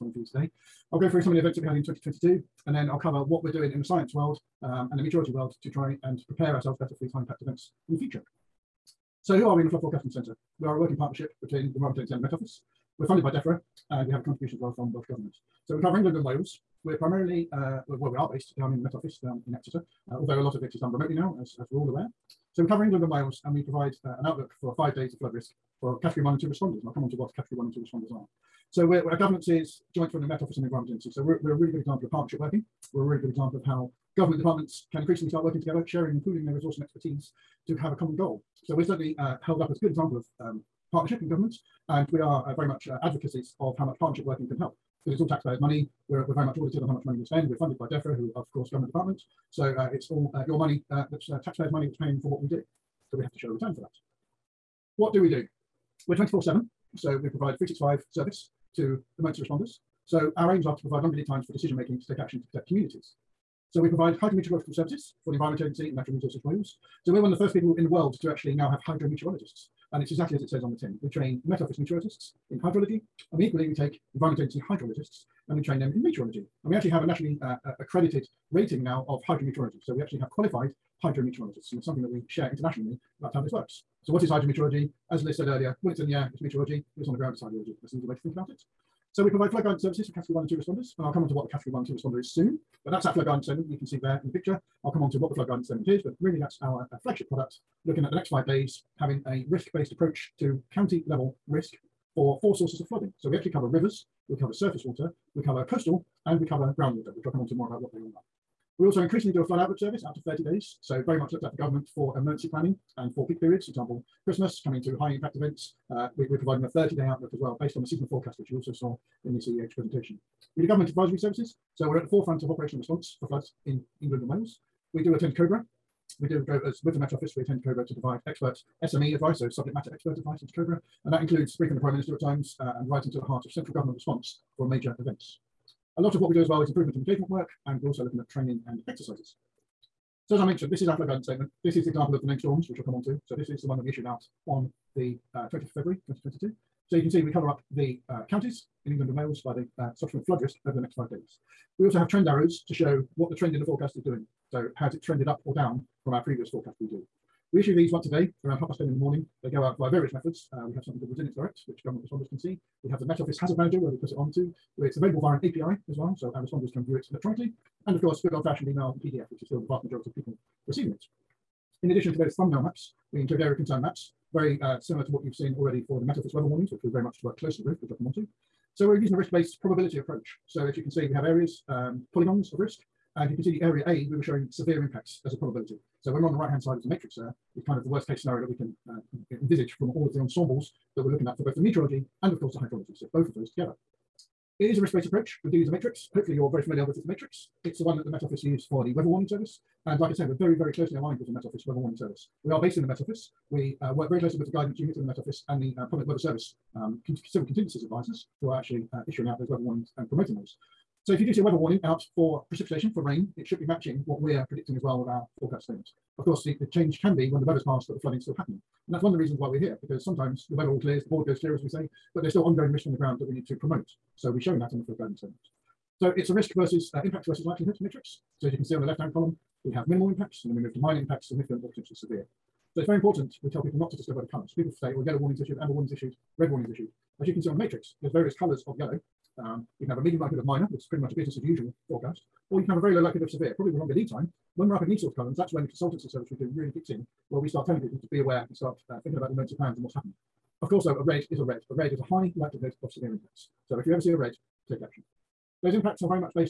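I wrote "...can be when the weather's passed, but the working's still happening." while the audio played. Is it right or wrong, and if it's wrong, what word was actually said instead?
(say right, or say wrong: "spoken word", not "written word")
wrong: "flooding", not "working".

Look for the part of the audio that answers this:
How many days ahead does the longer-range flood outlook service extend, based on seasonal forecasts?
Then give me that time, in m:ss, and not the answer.
1:50.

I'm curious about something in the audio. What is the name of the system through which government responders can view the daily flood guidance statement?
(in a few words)
Resilience Direct.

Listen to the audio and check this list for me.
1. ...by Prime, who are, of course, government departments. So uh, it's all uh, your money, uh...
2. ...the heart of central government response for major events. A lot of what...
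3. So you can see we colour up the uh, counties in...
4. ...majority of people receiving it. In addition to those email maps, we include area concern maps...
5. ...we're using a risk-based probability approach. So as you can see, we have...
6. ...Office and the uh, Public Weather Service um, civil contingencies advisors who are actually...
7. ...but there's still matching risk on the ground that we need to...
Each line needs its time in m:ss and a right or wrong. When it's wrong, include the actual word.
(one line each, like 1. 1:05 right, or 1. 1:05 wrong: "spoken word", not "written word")
1. 0:47 wrong: "DEFRA", not "Prime"
2. 2:13 right
3. 2:26 right
4. 2:49 wrong: "thumbnail", not "email"
5. 2:58 right
6. 3:25 right
7. 3:42 wrong: "ongoing", not "matching".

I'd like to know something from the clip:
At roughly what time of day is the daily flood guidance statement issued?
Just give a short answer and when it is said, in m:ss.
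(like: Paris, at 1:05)
10:30 in the morning, at 2:38.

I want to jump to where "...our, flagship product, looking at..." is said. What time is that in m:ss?
1:36.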